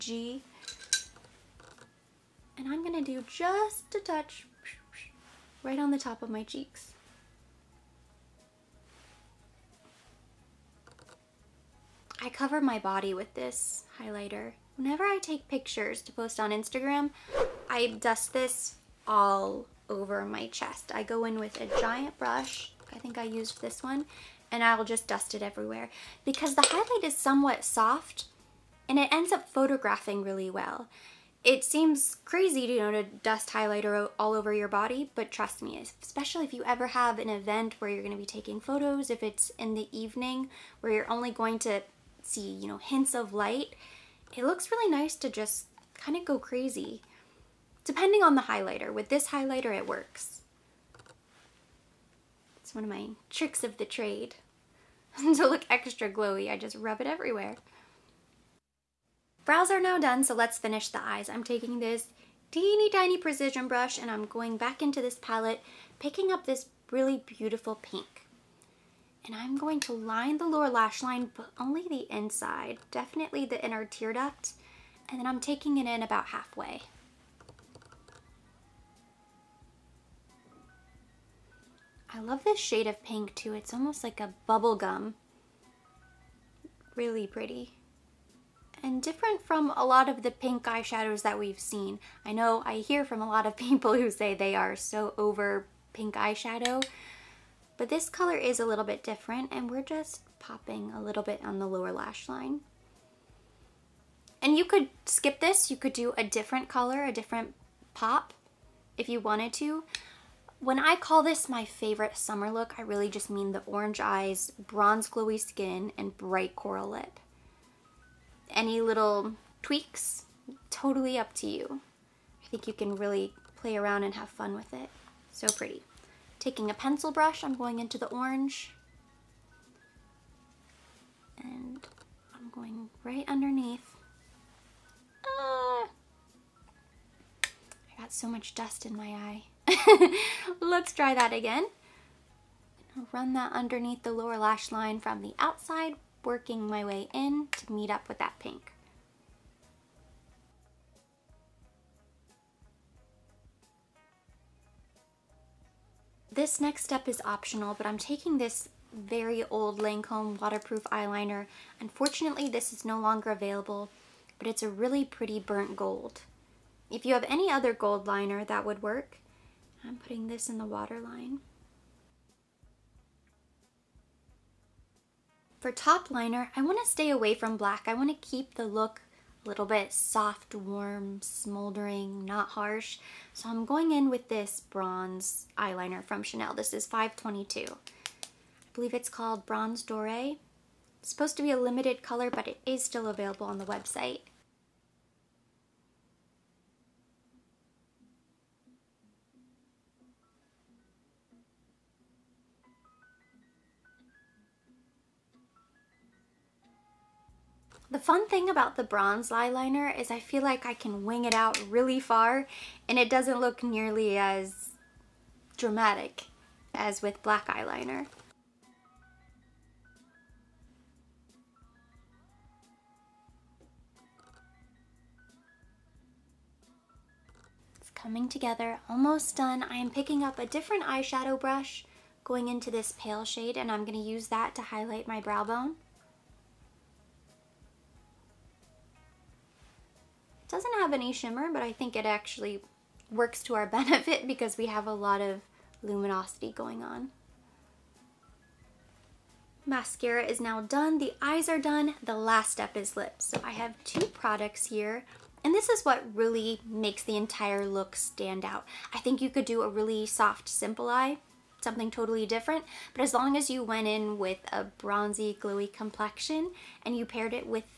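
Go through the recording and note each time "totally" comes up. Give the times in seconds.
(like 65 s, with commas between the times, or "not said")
120 s, 261 s.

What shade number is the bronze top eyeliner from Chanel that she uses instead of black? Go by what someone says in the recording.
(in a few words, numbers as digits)
522.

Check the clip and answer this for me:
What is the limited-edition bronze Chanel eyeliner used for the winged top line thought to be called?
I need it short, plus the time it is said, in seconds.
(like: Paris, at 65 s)
Bronze Doré, at 189 s.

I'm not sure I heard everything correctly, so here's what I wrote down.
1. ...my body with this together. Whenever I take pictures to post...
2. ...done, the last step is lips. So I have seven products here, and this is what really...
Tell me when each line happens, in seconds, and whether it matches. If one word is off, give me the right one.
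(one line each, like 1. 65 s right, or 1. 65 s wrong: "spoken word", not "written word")
1. 12 s wrong: "highlighter", not "together"
2. 251 s wrong: "two", not "seven".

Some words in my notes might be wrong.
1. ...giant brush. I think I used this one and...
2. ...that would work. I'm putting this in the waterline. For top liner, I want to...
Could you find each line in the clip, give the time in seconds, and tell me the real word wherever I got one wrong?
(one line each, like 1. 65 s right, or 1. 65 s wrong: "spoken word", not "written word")
1. 21 s right
2. 168 s right.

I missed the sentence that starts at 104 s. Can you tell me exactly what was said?
And you could skip this, you could do a different color, a different pop if you wanted to.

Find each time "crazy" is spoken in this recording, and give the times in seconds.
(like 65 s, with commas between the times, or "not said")
32 s, 46 s.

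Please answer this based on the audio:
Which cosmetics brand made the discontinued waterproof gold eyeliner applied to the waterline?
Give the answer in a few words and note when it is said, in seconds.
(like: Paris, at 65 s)
Lancome, at 159 s.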